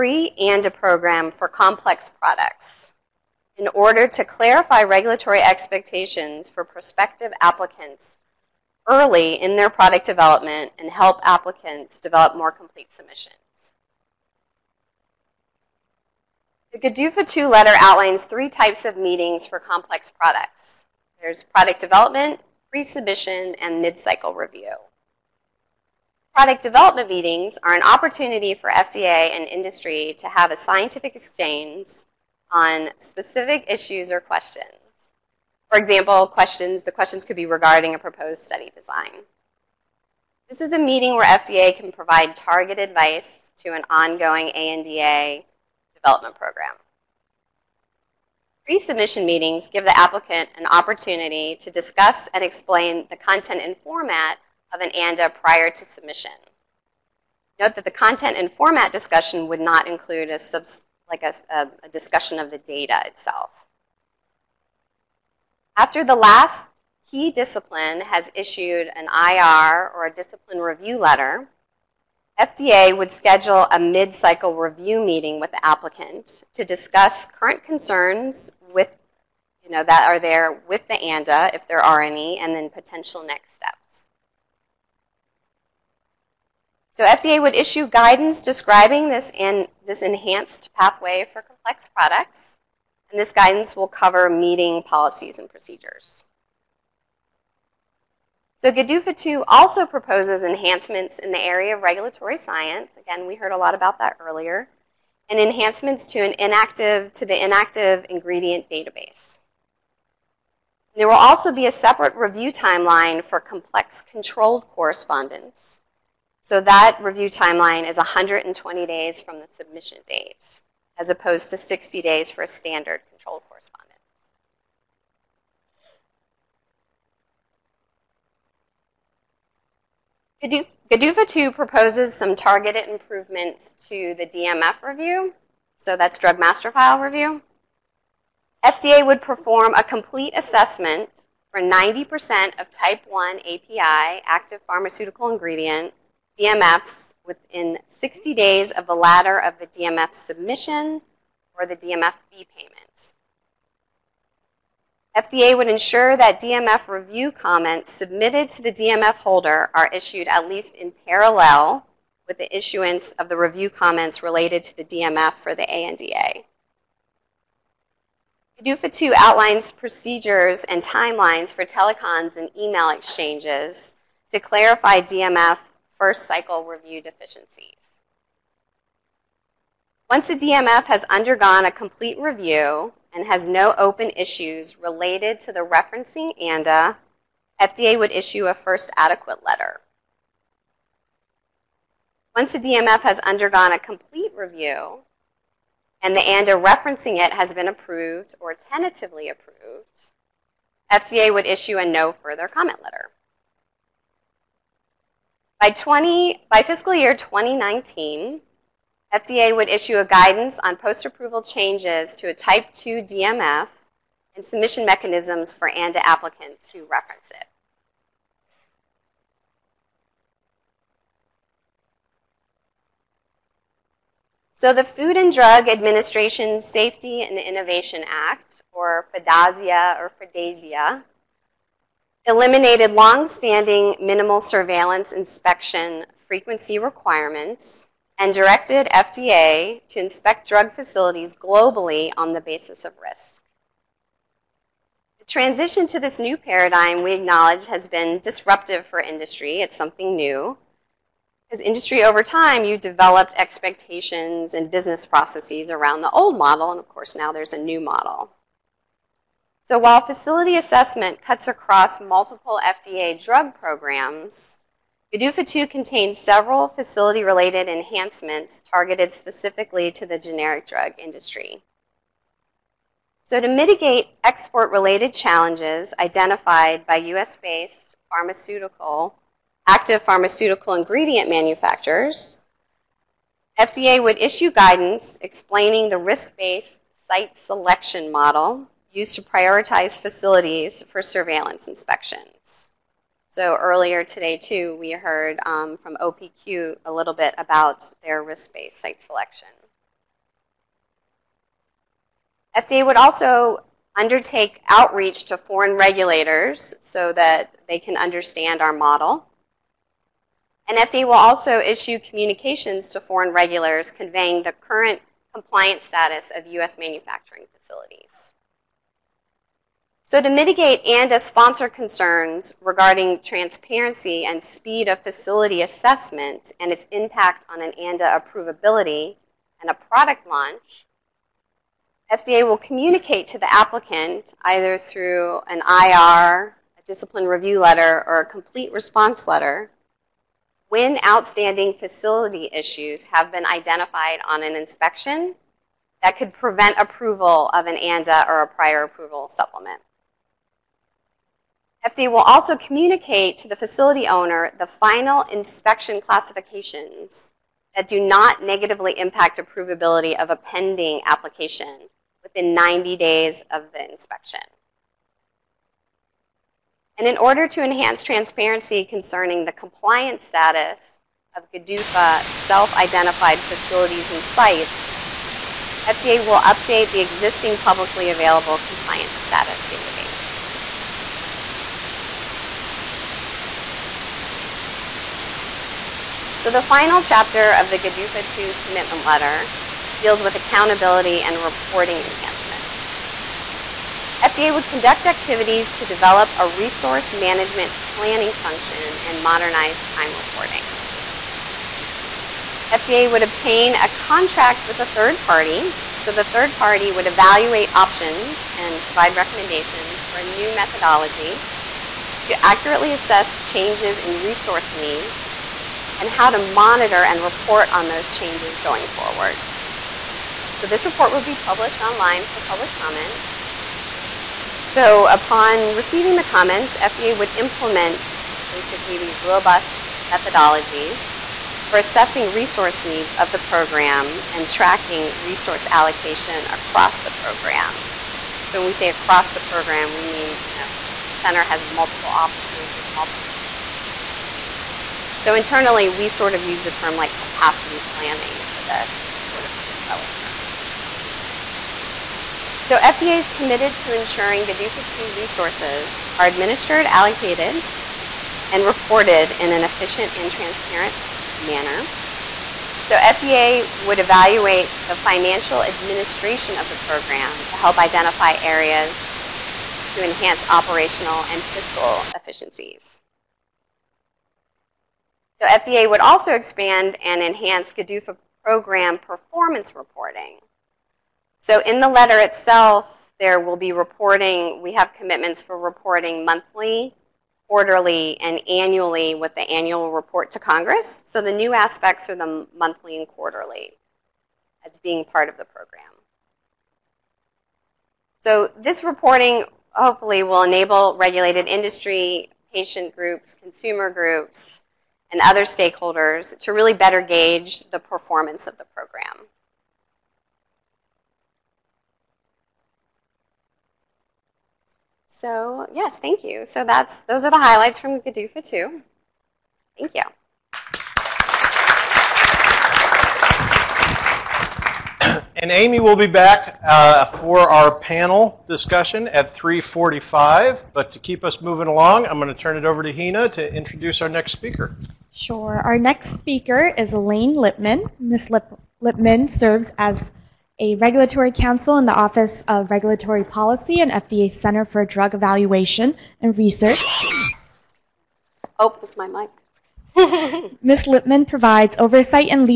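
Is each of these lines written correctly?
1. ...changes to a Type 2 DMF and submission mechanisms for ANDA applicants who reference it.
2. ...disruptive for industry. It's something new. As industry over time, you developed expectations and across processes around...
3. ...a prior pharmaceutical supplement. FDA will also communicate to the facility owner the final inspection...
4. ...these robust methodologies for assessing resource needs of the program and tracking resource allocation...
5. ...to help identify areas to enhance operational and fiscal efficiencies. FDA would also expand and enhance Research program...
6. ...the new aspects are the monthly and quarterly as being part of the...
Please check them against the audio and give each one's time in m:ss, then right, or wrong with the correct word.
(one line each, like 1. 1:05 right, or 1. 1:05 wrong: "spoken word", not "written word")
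1. 3:31 right
2. 4:08 wrong: "business", not "across"
3. 5:48 wrong: "approval", not "pharmaceutical"
4. 7:08 right
5. 7:47 wrong: "GDUFA", not "Research"
6. 8:11 right.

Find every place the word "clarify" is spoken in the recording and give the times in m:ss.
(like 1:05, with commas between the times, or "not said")
0:04, 2:54.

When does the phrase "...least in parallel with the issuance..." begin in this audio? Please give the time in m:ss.
2:40.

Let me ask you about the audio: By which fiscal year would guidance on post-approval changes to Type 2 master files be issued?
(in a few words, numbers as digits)
2019.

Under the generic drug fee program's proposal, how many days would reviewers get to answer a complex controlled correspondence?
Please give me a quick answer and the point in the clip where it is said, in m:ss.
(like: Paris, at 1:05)
120 days, at 1:57.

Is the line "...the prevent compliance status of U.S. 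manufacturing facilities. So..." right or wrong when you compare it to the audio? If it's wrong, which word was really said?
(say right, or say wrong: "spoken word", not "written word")
wrong: "current", not "prevent".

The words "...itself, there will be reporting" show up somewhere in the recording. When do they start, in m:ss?
8:02.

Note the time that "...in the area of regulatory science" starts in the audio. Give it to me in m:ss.
1:41.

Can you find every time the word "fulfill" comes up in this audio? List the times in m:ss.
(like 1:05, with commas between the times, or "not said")
not said.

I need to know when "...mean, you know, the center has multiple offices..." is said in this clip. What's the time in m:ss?
7:20.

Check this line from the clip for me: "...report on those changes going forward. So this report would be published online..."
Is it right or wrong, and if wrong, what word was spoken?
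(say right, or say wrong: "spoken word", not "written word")
right.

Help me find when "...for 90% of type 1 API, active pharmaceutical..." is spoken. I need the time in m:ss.
2:21.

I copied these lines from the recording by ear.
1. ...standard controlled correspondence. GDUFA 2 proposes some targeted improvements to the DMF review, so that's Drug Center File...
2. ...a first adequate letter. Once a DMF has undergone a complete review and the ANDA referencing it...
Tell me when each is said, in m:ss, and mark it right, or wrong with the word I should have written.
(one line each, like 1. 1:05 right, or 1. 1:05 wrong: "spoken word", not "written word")
1. 2:02 wrong: "Master", not "Center"
2. 3:08 right.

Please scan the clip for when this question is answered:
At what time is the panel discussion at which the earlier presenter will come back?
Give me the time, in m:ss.
8:49.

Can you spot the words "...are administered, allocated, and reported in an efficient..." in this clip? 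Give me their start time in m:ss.
7:36.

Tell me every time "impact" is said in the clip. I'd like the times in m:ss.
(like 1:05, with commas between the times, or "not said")
5:26, 5:58.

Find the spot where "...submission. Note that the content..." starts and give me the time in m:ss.
0:55.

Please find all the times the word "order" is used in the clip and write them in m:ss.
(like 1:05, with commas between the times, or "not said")
0:03, 6:07.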